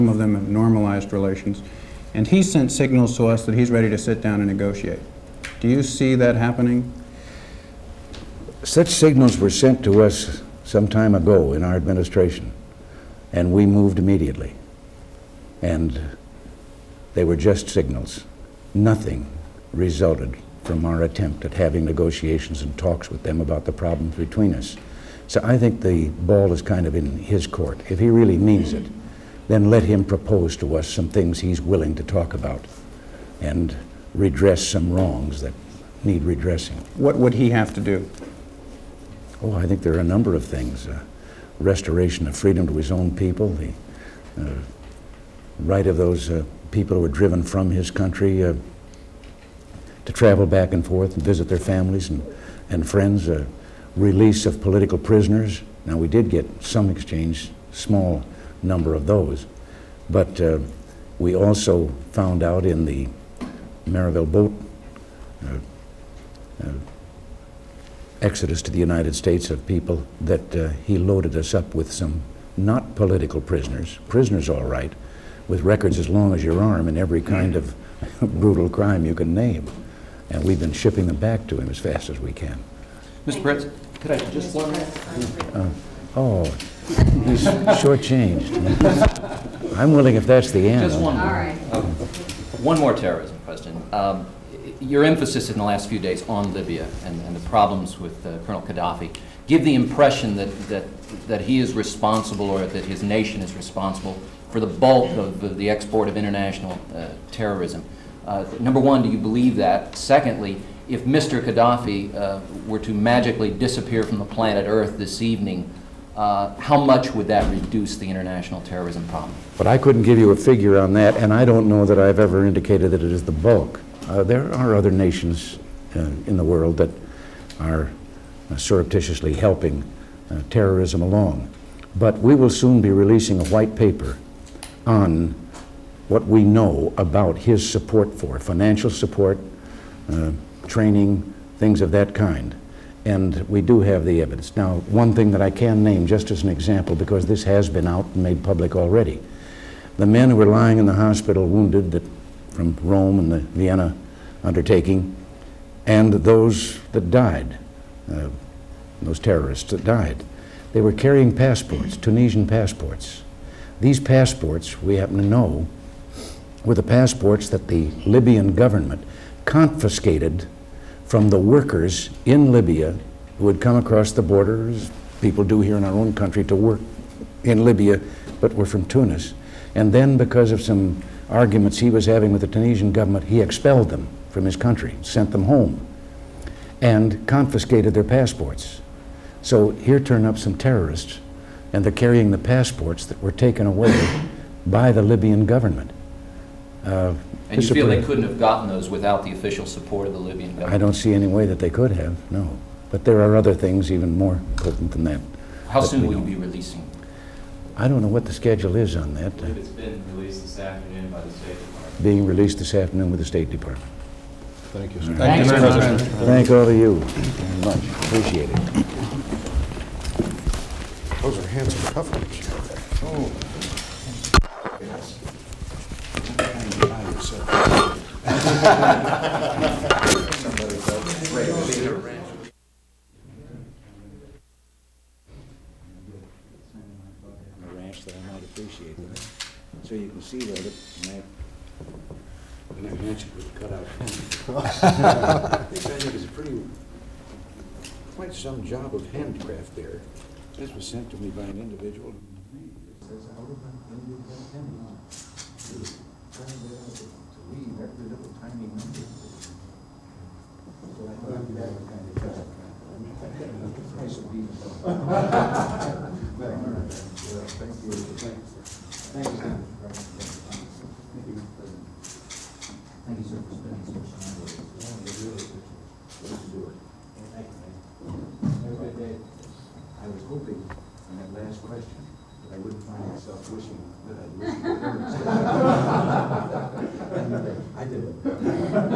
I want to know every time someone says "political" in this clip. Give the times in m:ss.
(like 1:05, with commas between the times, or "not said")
0:54, 1:12.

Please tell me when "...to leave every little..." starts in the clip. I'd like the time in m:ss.
4:16.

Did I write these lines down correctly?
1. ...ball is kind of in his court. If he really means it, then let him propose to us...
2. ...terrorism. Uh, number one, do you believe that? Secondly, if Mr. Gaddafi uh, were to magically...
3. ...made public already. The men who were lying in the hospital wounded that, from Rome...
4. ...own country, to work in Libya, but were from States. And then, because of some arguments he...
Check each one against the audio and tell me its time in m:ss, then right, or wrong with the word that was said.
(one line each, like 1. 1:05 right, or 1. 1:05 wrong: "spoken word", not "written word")
1. 0:26 right
2. 1:47 right
3. 2:28 right
4. 2:55 wrong: "Tunis", not "States".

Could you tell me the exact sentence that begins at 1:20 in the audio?
And we've been shipping them back to him as fast as we can.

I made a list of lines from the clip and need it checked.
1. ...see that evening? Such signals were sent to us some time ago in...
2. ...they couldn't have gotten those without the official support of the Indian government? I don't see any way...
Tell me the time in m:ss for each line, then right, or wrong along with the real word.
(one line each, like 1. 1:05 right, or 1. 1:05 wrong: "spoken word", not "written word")
1. 0:05 wrong: "happening", not "evening"
2. 3:17 wrong: "Libyan", not "Indian".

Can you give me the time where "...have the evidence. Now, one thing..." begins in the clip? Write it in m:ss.
2:23.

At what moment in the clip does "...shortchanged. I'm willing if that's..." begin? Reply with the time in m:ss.
1:27.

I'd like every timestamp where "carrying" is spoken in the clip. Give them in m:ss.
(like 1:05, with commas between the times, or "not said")
2:40, 3:11.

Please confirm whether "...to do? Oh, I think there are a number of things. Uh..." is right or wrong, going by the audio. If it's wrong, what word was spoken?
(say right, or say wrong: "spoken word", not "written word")
right.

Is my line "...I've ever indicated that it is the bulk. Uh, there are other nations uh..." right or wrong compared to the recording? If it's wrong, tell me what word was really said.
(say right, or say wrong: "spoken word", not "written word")
right.